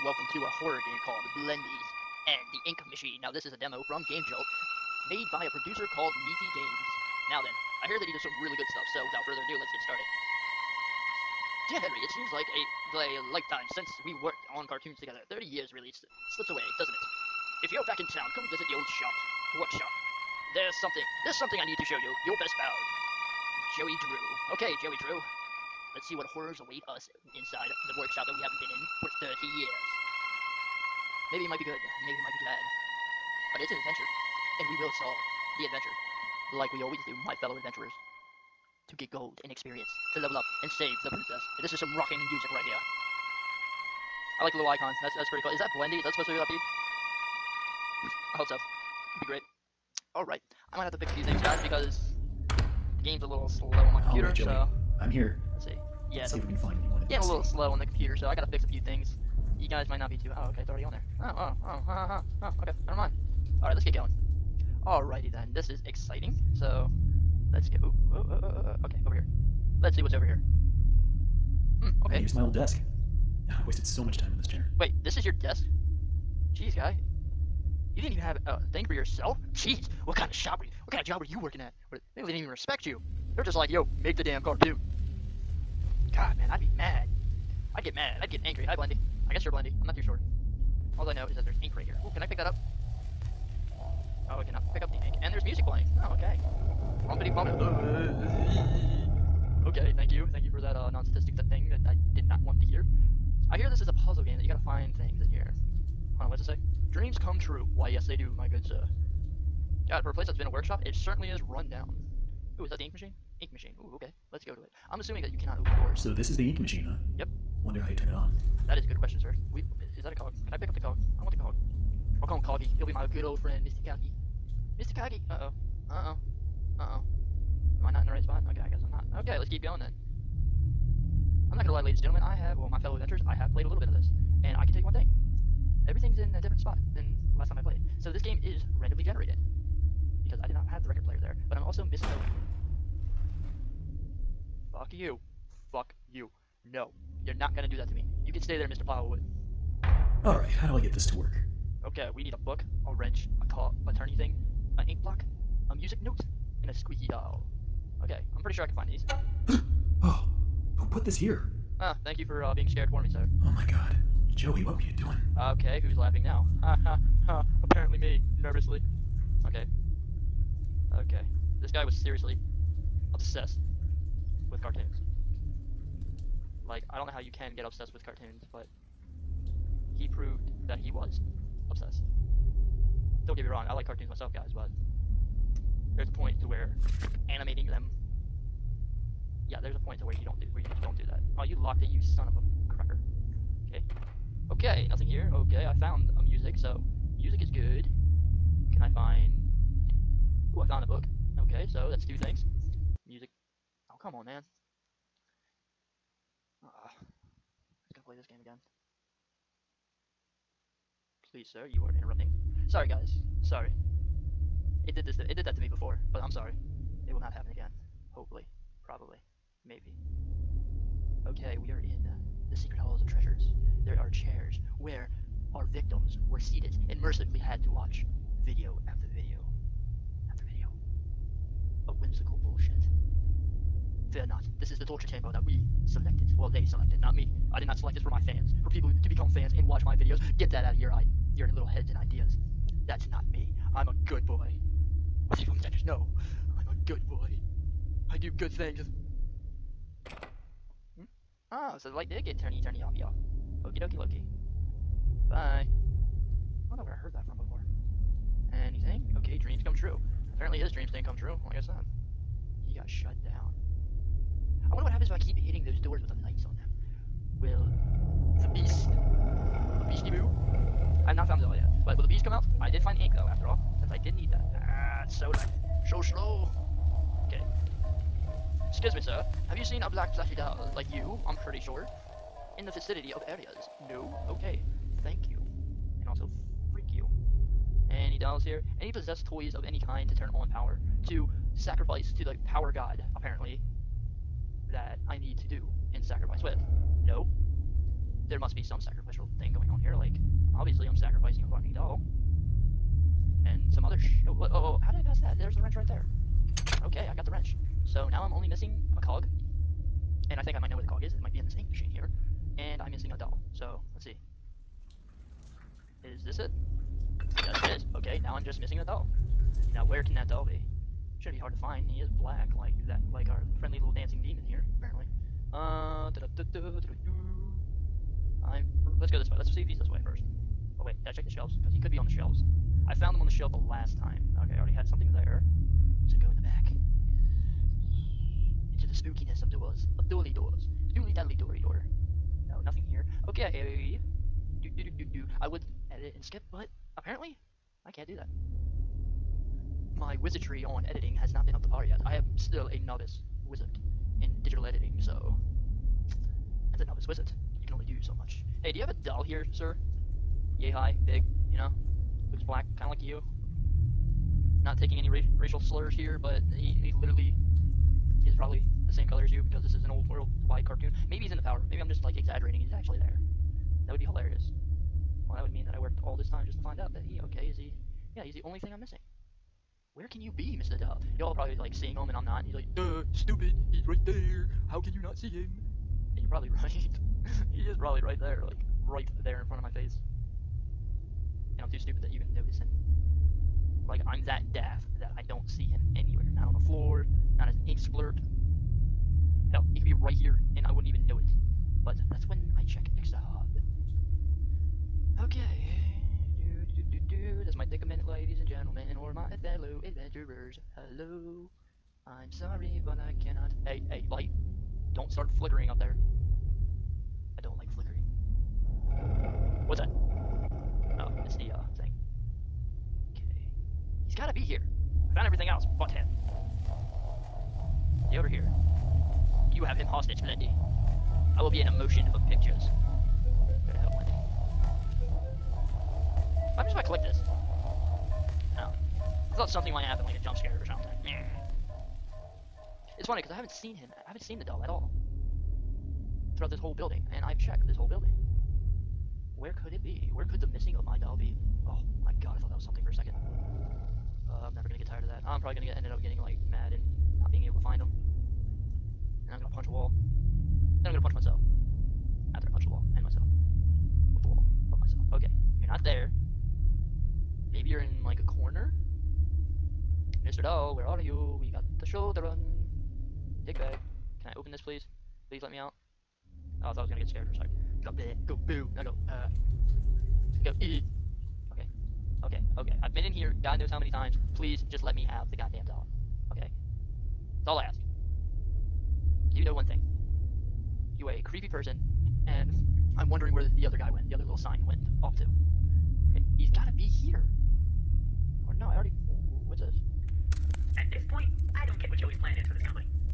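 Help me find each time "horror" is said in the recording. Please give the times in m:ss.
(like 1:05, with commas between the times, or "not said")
0:00, 0:26.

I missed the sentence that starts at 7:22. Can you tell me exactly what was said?
It's funny, because I haven't seen him.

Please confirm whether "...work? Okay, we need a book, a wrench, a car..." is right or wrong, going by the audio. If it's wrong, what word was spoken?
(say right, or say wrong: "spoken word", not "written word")
right.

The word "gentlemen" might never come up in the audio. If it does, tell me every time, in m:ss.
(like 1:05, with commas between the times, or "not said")
2:12, 6:48.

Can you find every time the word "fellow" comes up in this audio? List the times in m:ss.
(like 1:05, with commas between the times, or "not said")
0:37, 2:12, 6:49.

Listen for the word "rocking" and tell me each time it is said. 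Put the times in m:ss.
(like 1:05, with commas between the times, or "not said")
0:41.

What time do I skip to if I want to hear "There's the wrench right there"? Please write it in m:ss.
5:05.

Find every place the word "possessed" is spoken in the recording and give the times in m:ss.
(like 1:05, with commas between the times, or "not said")
4:48.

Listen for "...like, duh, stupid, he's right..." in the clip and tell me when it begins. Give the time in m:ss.
6:22.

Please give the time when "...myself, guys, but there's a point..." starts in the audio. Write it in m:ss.
3:04.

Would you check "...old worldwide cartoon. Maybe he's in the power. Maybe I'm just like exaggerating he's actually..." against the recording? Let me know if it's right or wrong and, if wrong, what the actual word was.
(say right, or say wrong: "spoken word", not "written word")
right.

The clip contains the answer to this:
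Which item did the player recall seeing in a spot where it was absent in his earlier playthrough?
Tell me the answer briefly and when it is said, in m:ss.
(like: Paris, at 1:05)
record player, at 2:20.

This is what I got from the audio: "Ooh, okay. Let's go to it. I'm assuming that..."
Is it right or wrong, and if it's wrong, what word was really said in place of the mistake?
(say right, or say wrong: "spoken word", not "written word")
right.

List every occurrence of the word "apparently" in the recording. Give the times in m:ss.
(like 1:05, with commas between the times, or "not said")
2:47, 4:20, 4:53, 5:24, 5:46.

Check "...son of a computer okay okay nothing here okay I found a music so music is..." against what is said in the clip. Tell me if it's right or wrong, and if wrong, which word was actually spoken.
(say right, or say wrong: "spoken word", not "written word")
wrong: "cracker", not "computer".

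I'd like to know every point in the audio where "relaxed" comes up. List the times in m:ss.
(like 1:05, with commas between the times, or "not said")
not said.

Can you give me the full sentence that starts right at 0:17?
If you're back in town, come visit the old shop, workshop.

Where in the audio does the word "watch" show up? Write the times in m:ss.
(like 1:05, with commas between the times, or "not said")
3:47, 3:59.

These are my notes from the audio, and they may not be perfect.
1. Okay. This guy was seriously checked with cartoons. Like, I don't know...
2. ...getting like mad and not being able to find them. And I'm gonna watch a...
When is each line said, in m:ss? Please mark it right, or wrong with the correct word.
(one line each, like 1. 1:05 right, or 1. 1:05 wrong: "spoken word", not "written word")
1. 2:50 wrong: "obsessed", not "checked"
2. 7:36 wrong: "punch", not "watch".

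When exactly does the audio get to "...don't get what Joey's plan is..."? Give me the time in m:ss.
8:21.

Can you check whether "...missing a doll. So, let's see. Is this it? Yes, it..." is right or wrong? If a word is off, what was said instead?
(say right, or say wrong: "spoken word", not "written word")
right.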